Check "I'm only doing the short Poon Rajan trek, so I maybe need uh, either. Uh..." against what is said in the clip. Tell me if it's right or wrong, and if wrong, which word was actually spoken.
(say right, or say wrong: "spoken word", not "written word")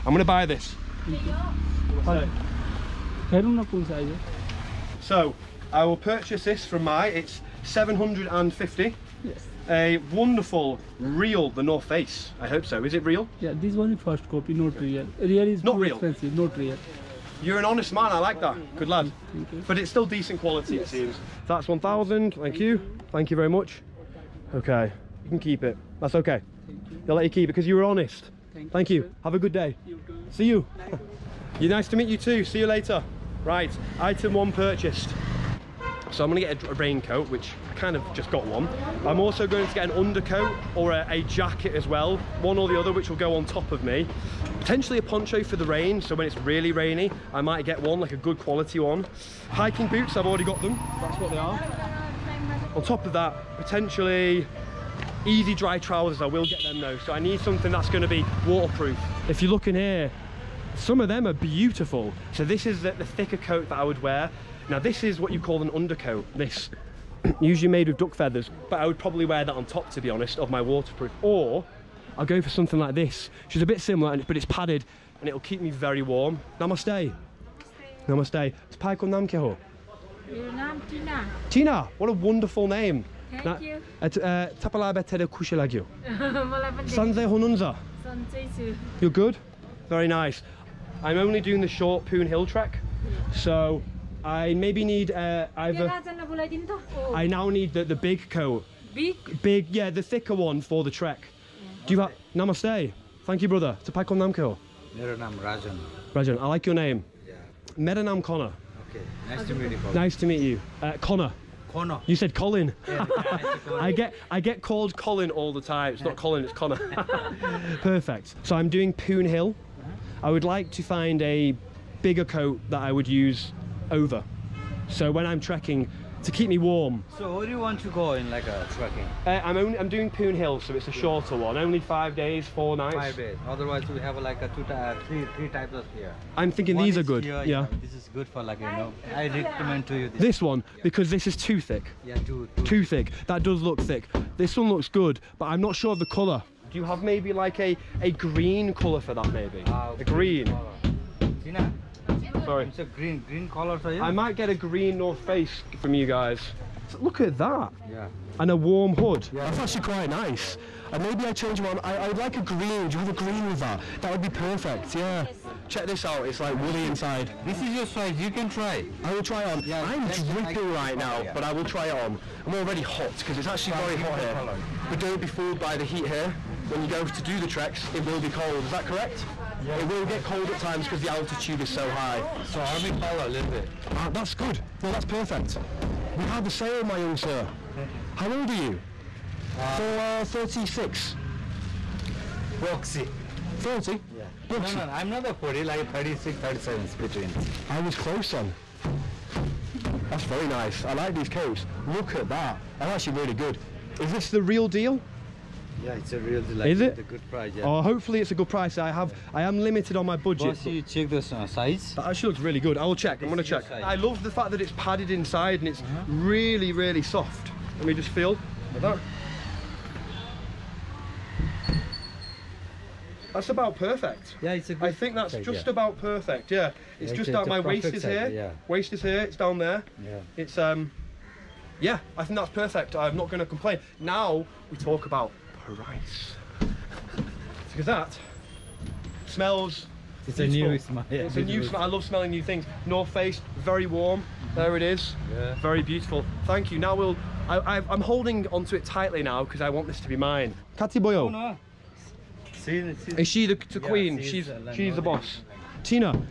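wrong: "Hill", not "Rajan".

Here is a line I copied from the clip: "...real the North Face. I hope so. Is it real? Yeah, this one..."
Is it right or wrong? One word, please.
right.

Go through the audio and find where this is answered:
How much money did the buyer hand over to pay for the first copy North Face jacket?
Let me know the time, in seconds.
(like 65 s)
21 s.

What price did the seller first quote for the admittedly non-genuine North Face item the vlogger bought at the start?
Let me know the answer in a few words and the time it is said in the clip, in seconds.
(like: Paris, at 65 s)
750, at 7 s.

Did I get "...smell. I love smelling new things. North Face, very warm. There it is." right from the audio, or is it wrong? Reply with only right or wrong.
right.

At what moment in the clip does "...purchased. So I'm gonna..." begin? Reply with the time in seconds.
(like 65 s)
34 s.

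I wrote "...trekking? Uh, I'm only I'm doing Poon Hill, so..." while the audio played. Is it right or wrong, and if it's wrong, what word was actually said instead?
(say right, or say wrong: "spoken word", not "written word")
right.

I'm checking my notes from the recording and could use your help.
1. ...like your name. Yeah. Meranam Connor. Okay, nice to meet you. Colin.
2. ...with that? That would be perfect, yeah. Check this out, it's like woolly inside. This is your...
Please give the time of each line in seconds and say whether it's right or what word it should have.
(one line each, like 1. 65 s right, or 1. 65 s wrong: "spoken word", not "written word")
1. 106 s right
2. 163 s right.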